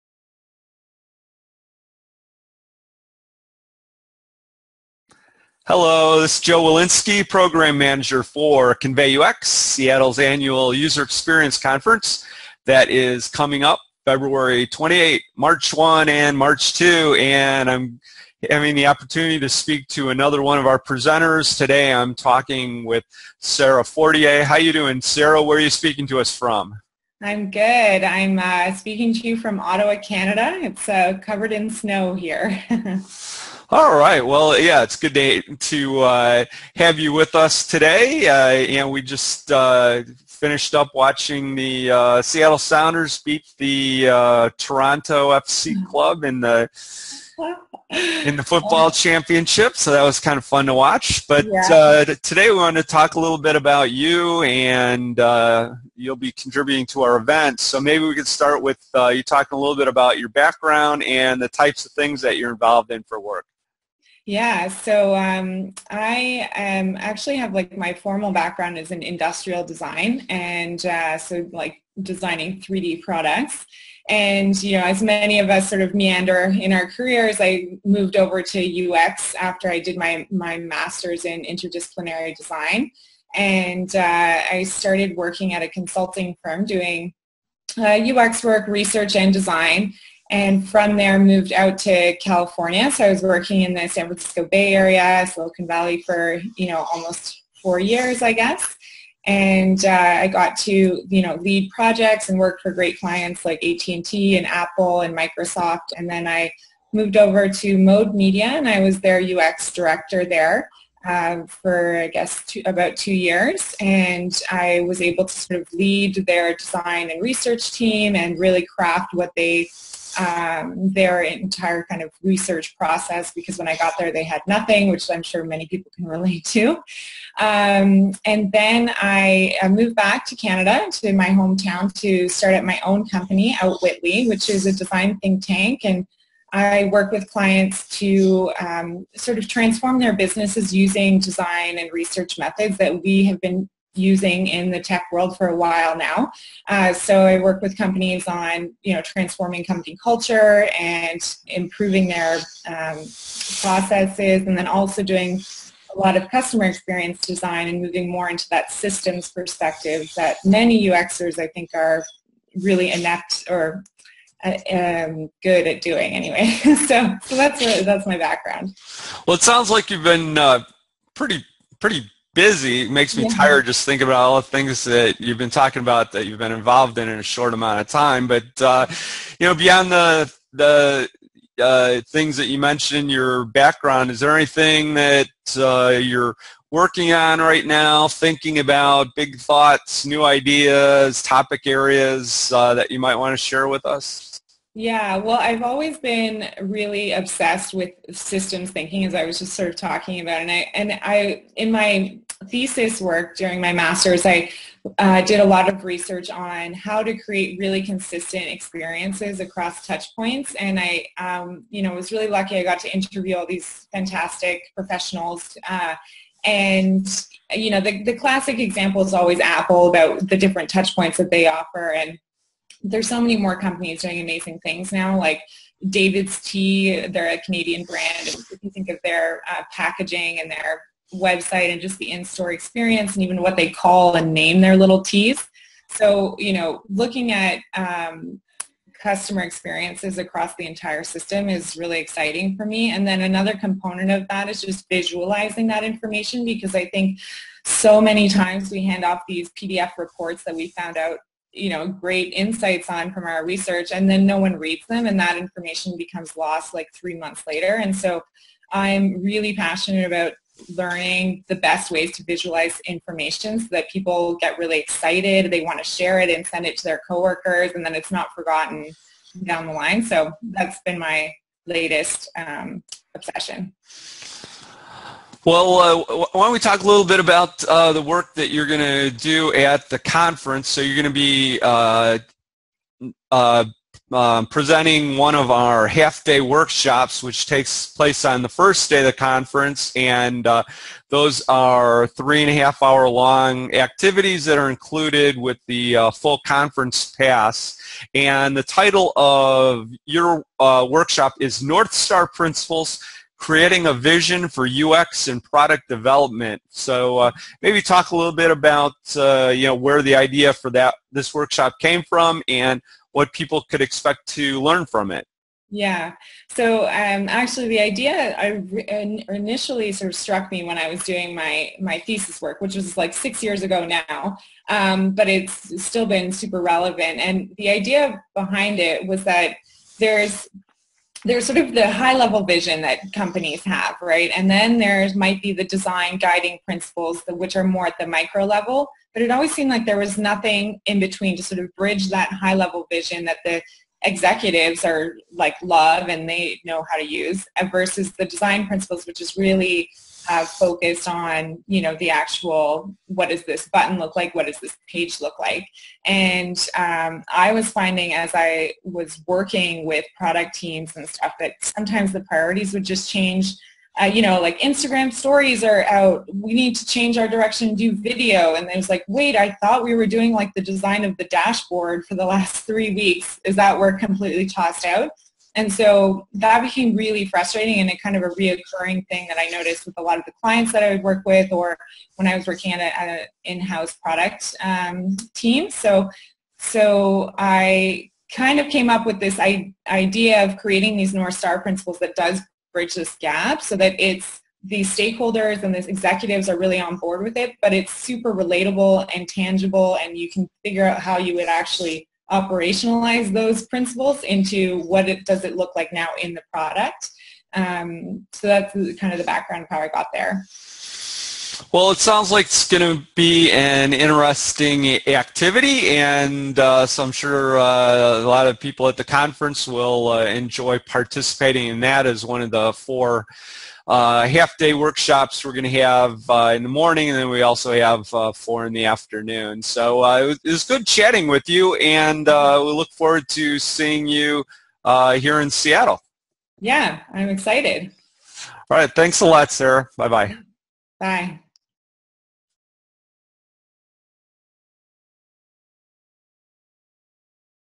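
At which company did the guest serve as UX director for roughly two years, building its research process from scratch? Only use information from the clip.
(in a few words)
Mode Media.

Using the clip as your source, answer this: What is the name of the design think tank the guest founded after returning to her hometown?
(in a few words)
Outwitly.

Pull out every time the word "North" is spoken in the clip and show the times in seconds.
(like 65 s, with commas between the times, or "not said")
301 s, 391 s.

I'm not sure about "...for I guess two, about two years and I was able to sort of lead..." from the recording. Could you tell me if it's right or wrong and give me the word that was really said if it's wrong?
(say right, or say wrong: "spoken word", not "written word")
right.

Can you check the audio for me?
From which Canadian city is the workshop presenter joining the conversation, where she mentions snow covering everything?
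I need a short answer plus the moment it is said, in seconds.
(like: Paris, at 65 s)
Ottawa, at 29 s.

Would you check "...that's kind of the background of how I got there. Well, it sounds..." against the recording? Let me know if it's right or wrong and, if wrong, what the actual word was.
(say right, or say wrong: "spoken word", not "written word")
right.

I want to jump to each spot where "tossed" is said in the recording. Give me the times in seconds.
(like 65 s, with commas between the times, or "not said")
374 s.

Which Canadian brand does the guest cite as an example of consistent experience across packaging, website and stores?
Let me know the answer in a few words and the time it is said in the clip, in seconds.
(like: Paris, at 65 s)
David's Tea, at 225 s.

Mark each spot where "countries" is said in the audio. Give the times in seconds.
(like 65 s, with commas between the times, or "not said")
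not said.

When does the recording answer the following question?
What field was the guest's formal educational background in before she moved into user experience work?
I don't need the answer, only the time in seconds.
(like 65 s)
69 s.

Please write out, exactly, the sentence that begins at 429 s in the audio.
So it was, it, was, good chatting with you, and we look forward to seeing you here in Seattle.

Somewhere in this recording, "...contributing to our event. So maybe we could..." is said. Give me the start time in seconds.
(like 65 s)
56 s.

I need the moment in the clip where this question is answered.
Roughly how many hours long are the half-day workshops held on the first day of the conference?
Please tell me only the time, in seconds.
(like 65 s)
292 s.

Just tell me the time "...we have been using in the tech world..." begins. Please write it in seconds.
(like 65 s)
143 s.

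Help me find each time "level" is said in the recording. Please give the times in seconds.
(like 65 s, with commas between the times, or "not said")
332 s, 338 s, 342 s.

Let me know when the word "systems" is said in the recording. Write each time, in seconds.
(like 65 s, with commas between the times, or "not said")
158 s, 198 s, 241 s.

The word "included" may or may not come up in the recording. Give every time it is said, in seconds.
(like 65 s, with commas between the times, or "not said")
294 s.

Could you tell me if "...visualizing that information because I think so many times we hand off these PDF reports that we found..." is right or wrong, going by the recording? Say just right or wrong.
right.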